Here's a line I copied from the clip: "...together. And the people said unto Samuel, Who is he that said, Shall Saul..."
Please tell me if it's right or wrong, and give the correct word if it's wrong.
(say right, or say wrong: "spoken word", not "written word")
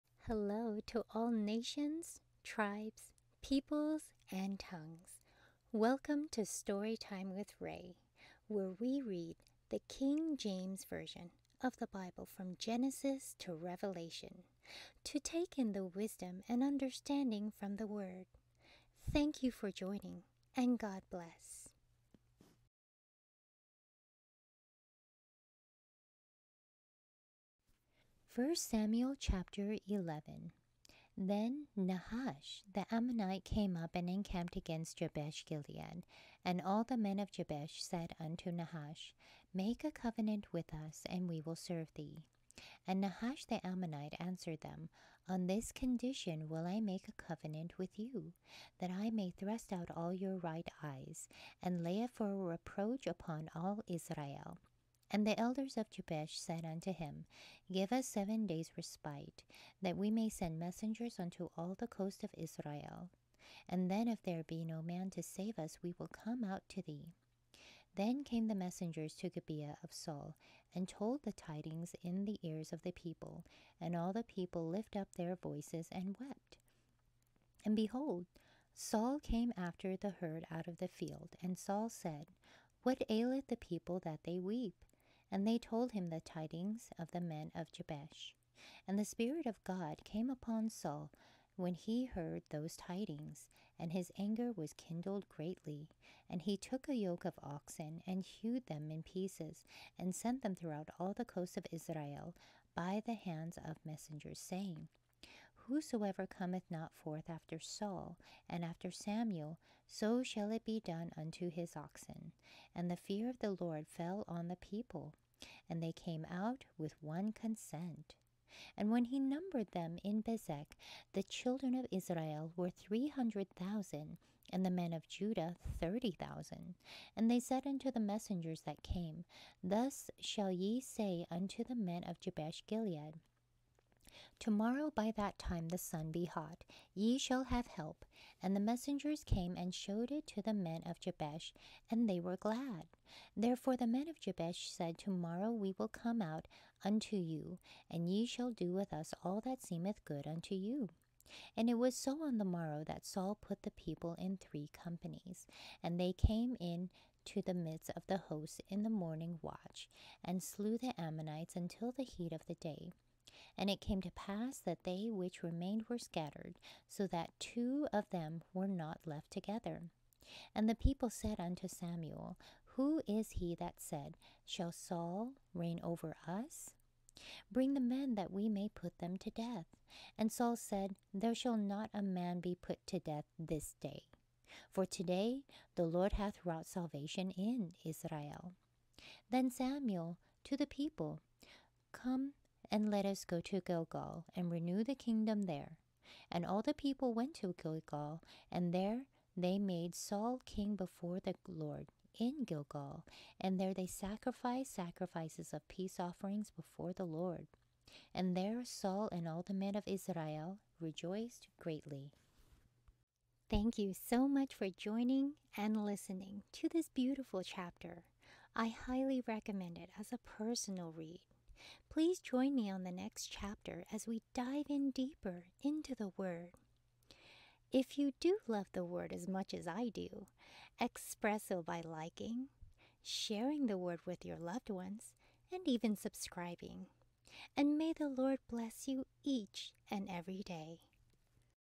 right.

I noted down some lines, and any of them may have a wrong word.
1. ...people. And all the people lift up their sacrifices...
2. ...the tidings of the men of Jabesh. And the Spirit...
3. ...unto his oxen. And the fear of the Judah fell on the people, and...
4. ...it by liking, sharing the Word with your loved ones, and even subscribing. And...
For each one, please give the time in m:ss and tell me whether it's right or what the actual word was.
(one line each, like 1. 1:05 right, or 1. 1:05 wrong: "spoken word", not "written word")
1. 1:12 wrong: "voices", not "sacrifices"
2. 1:26 right
3. 1:51 wrong: "Lord", not "Judah"
4. 3:51 right.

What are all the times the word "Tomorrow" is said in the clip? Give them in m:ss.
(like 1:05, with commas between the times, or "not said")
2:14, 2:24.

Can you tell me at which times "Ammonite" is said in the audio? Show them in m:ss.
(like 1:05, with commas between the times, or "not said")
0:32, 0:43, 2:40.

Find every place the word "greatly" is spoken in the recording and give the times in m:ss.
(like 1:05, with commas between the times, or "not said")
1:35, 3:31.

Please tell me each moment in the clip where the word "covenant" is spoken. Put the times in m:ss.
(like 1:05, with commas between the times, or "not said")
0:39, 0:47.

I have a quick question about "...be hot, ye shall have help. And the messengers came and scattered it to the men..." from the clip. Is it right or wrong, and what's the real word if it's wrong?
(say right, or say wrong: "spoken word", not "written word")
wrong: "showed", not "scattered".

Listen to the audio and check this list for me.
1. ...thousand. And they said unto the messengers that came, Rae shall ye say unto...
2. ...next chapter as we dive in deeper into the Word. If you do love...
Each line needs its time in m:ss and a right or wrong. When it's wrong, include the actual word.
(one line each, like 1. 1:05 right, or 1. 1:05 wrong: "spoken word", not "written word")
1. 2:06 wrong: "Thus", not "Rae"
2. 3:42 right.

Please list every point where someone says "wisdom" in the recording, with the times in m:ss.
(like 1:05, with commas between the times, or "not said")
0:15.